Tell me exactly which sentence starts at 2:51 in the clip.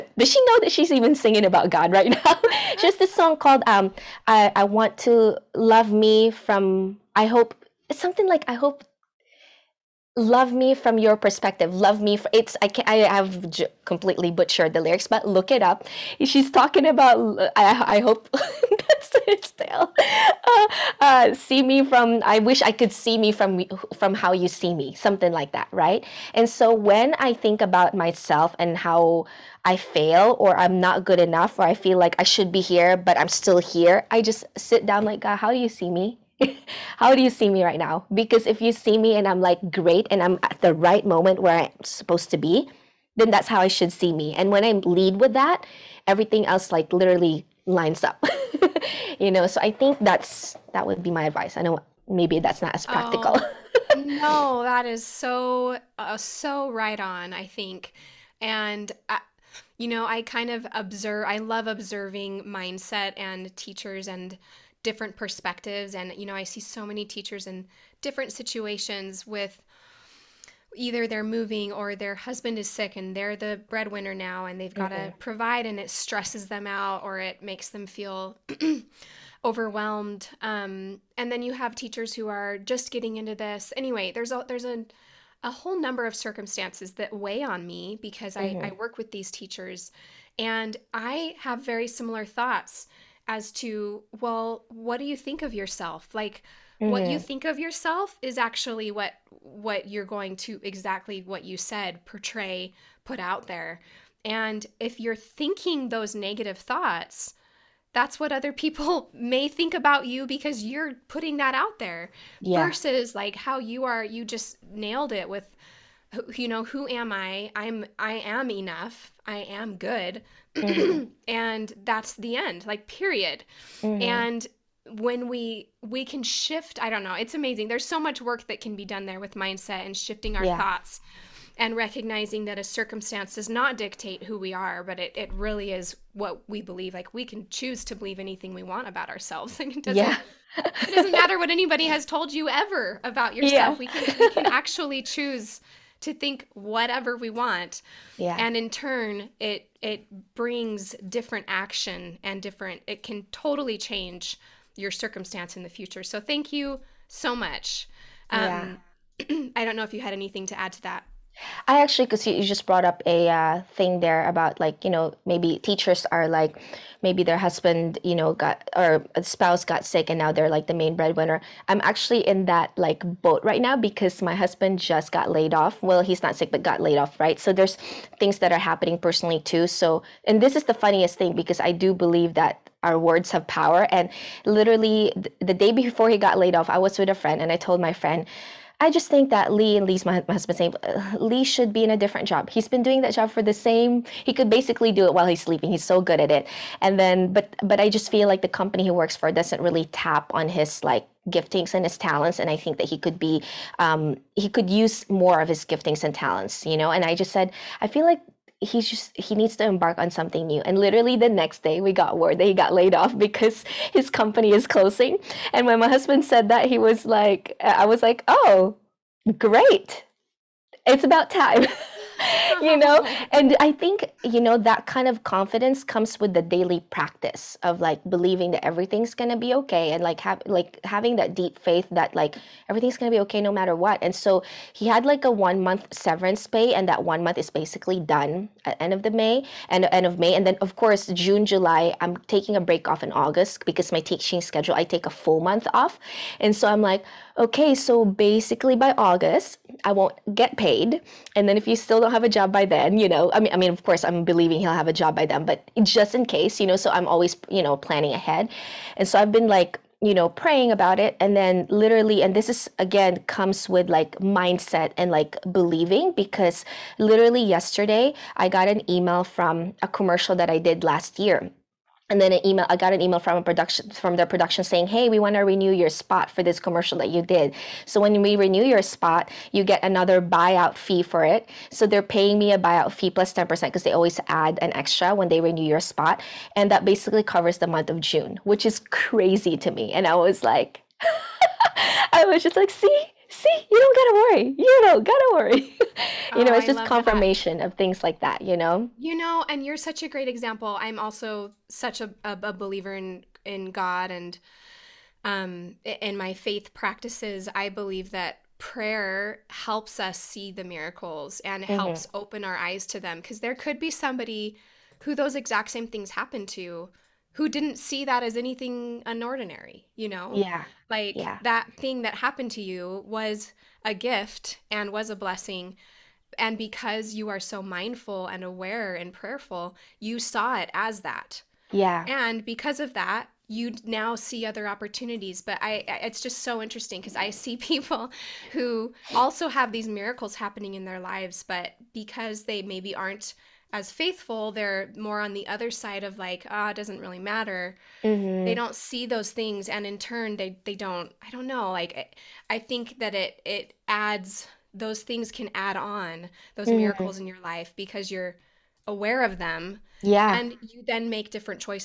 I'm actually in that like boat right now because my husband just got laid off.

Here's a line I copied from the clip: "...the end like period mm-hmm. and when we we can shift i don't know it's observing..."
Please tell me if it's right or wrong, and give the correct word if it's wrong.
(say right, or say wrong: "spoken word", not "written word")
wrong: "amazing", not "observing".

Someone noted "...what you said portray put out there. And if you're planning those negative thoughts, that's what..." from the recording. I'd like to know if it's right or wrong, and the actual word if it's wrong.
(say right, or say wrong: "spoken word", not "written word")
wrong: "thinking", not "planning".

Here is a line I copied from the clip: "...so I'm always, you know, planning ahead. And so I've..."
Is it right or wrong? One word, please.
right.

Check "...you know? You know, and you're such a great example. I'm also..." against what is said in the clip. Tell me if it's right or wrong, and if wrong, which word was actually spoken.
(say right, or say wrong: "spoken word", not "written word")
right.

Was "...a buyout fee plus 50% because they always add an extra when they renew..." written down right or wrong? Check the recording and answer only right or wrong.
wrong.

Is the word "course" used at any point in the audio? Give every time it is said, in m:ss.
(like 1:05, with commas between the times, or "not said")
4:00, 4:13.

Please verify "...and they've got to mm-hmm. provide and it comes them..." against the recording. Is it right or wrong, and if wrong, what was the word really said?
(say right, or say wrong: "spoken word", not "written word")
wrong: "stresses", not "comes".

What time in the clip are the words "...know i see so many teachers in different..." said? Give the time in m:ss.
1:06.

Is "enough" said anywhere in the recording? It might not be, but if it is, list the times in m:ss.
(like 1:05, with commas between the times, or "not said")
0:31, 1:58.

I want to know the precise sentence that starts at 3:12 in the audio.
He's been doing that job for the same.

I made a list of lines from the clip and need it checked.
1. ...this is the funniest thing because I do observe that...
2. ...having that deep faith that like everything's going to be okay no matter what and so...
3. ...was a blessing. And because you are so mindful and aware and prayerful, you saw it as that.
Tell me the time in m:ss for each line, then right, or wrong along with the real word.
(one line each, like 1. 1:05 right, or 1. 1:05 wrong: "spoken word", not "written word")
1. 3:00 wrong: "believe", not "observe"
2. 3:50 right
3. 5:24 right.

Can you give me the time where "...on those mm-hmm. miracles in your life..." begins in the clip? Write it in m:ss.
5:55.